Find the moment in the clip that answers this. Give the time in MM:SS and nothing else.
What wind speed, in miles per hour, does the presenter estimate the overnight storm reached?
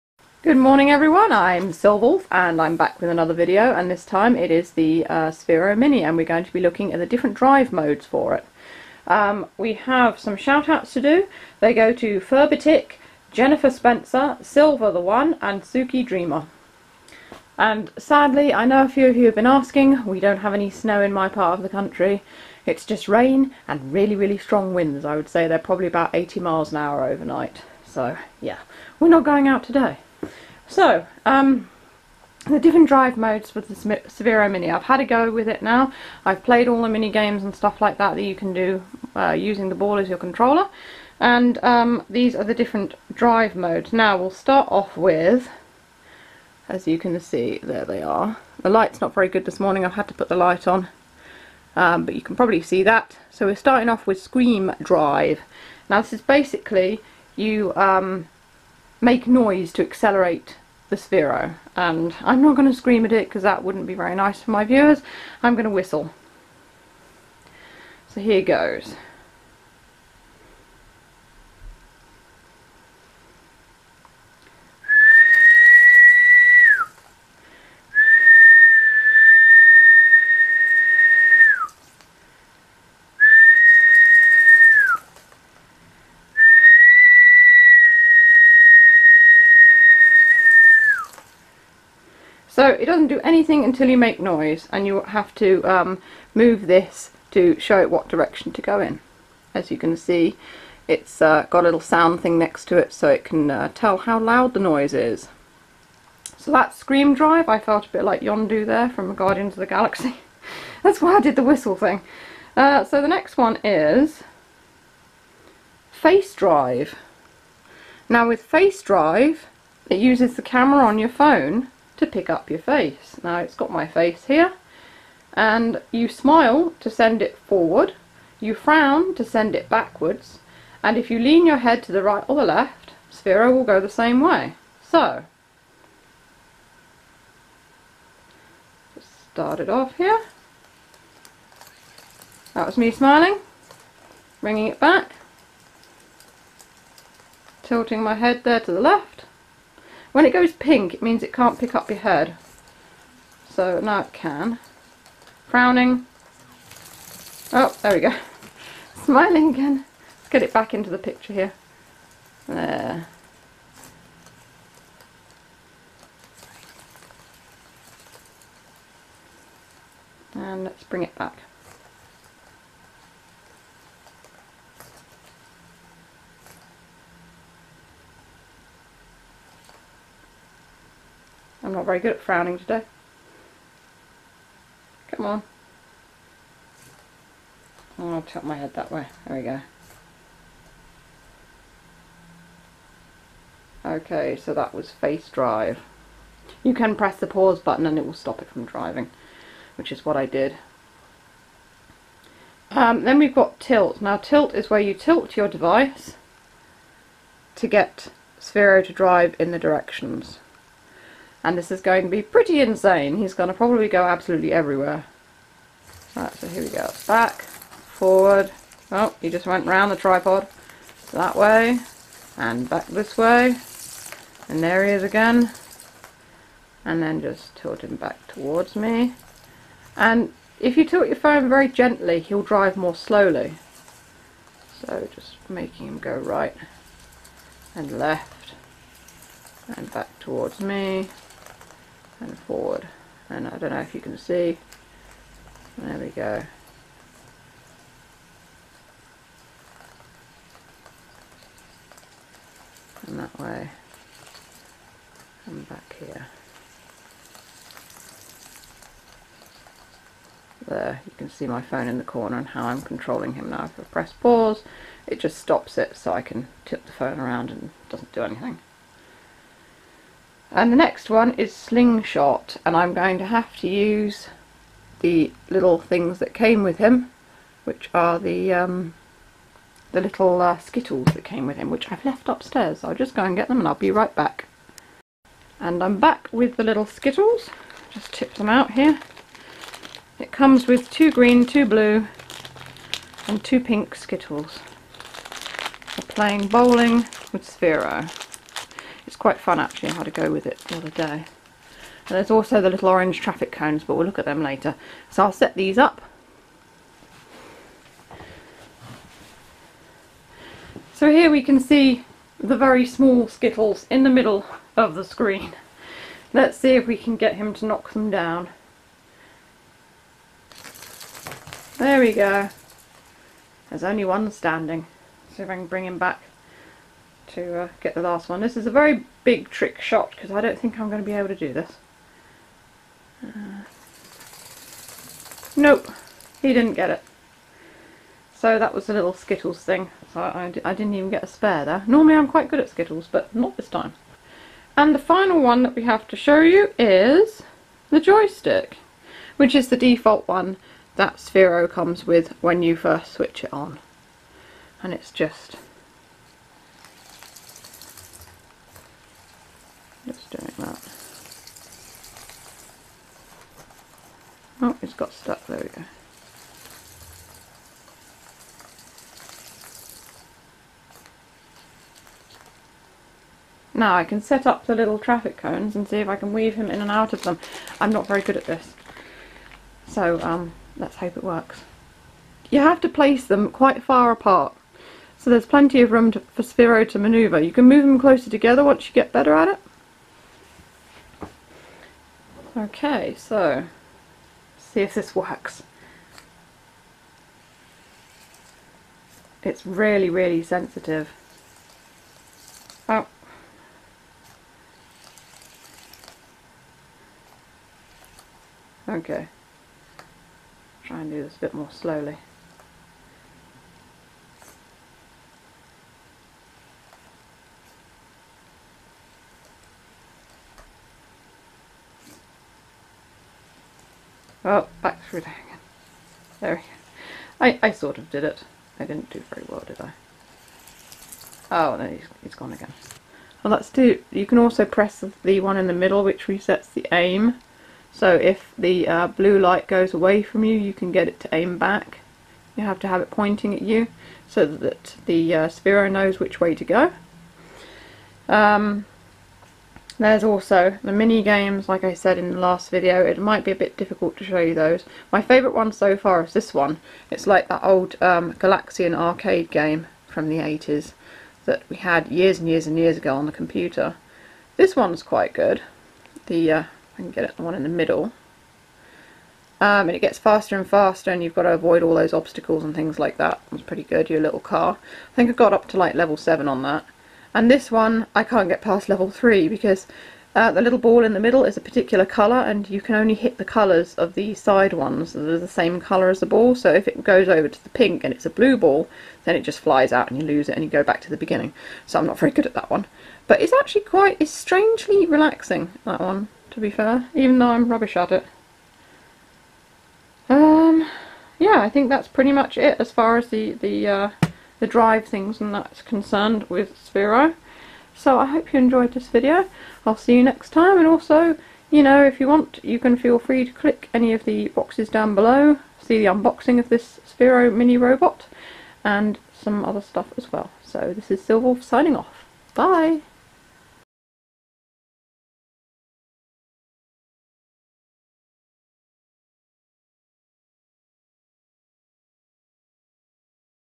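00:26.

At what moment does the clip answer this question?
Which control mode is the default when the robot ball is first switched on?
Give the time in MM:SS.
05:47.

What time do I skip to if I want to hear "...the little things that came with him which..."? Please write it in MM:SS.
04:34.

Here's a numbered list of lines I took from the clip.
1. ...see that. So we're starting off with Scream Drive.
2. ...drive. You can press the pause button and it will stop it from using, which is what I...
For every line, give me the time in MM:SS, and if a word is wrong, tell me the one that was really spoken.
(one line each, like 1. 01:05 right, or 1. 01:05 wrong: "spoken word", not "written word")
1. 00:52 right
2. 03:15 wrong: "driving", not "using".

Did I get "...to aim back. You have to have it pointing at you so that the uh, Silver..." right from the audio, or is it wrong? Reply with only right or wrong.
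wrong.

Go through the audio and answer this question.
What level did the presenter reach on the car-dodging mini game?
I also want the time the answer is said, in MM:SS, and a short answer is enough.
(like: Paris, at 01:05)
7, at 07:55.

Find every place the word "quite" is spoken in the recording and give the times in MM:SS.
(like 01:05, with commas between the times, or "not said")
04:59, 05:42, 06:23, 07:45, 08:13.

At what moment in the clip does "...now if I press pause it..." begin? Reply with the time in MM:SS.
04:23.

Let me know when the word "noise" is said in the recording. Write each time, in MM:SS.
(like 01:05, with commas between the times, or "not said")
00:59, 01:34, 01:44.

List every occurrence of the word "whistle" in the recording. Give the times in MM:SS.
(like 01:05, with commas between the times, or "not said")
01:05, 01:51.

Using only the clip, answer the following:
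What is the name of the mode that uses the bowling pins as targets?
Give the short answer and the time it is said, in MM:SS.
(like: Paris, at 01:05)
Slingshot, at 04:31.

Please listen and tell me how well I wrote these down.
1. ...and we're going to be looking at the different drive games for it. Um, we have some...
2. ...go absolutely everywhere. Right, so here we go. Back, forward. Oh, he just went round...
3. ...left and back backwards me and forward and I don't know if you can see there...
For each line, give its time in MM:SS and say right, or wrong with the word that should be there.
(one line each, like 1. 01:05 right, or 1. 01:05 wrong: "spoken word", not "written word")
1. 00:06 wrong: "modes", not "games"
2. 03:33 right
3. 03:57 wrong: "towards", not "backwards".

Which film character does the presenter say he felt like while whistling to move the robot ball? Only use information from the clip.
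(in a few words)
Yondu.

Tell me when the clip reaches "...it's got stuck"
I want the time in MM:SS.
06:04.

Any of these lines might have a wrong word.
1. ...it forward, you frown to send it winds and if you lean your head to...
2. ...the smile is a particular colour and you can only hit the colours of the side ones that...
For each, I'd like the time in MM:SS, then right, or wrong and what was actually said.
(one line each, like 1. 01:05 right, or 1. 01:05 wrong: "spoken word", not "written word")
1. 02:07 wrong: "backwards", not "winds"
2. 08:01 wrong: "middle", not "smile".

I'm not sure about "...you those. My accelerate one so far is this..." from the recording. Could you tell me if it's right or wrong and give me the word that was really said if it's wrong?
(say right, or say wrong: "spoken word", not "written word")
wrong: "favourite", not "accelerate".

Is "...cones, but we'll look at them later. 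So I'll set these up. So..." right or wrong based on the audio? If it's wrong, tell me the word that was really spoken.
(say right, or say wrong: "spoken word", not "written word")
right.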